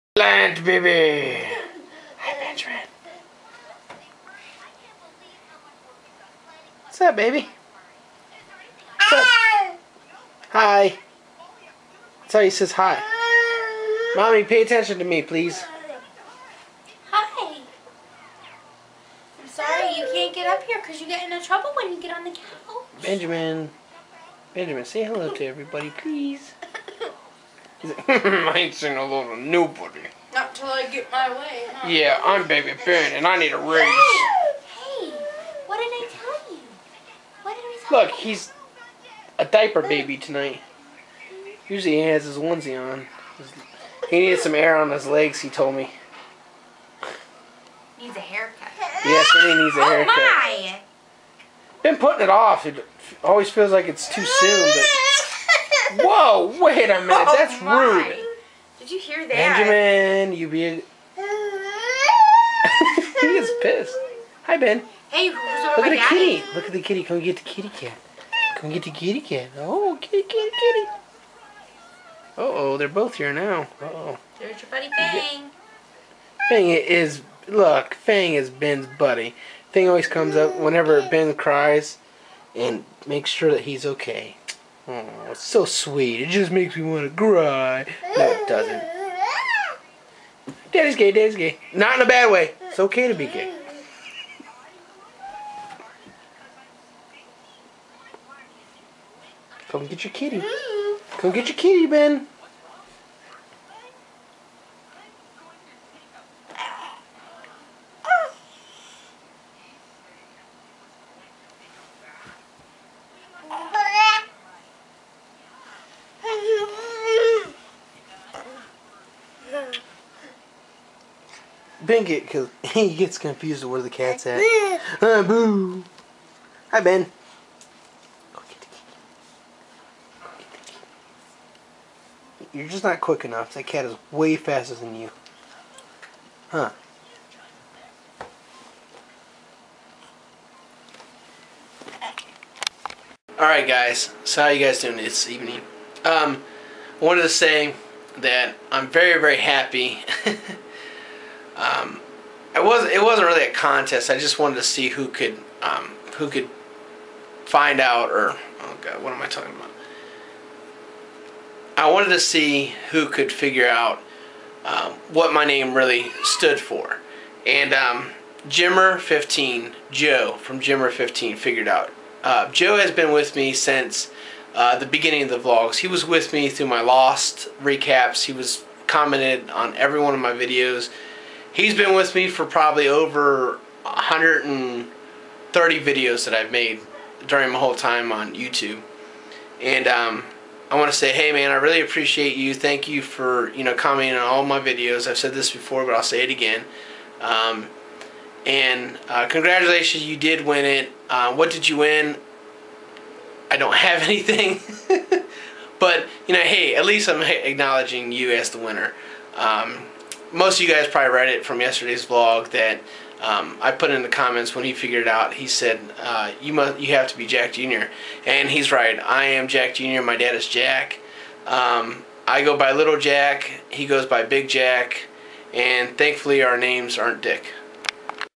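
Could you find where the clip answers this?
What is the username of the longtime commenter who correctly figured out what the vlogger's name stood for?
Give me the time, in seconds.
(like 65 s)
168 s.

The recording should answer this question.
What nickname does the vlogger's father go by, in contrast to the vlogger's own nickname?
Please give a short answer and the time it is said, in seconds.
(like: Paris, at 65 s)
Big Jack, at 224 s.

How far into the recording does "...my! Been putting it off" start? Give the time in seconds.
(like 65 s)
50 s.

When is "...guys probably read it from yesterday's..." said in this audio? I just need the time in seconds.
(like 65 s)
210 s.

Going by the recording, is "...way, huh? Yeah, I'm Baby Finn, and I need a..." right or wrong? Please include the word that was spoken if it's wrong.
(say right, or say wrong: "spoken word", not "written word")
right.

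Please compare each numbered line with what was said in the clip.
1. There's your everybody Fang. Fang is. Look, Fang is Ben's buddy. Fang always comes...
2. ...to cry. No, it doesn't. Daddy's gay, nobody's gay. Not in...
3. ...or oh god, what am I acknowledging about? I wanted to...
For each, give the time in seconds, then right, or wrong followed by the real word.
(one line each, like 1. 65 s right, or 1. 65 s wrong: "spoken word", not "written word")
1. 74 s wrong: "buddy", not "everybody"
2. 87 s wrong: "daddy", not "nobody"
3. 158 s wrong: "talking", not "acknowledging".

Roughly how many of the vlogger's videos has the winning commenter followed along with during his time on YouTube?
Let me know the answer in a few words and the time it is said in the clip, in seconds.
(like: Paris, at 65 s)
over 130, at 182 s.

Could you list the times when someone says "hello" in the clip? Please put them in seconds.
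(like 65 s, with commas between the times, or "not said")
25 s.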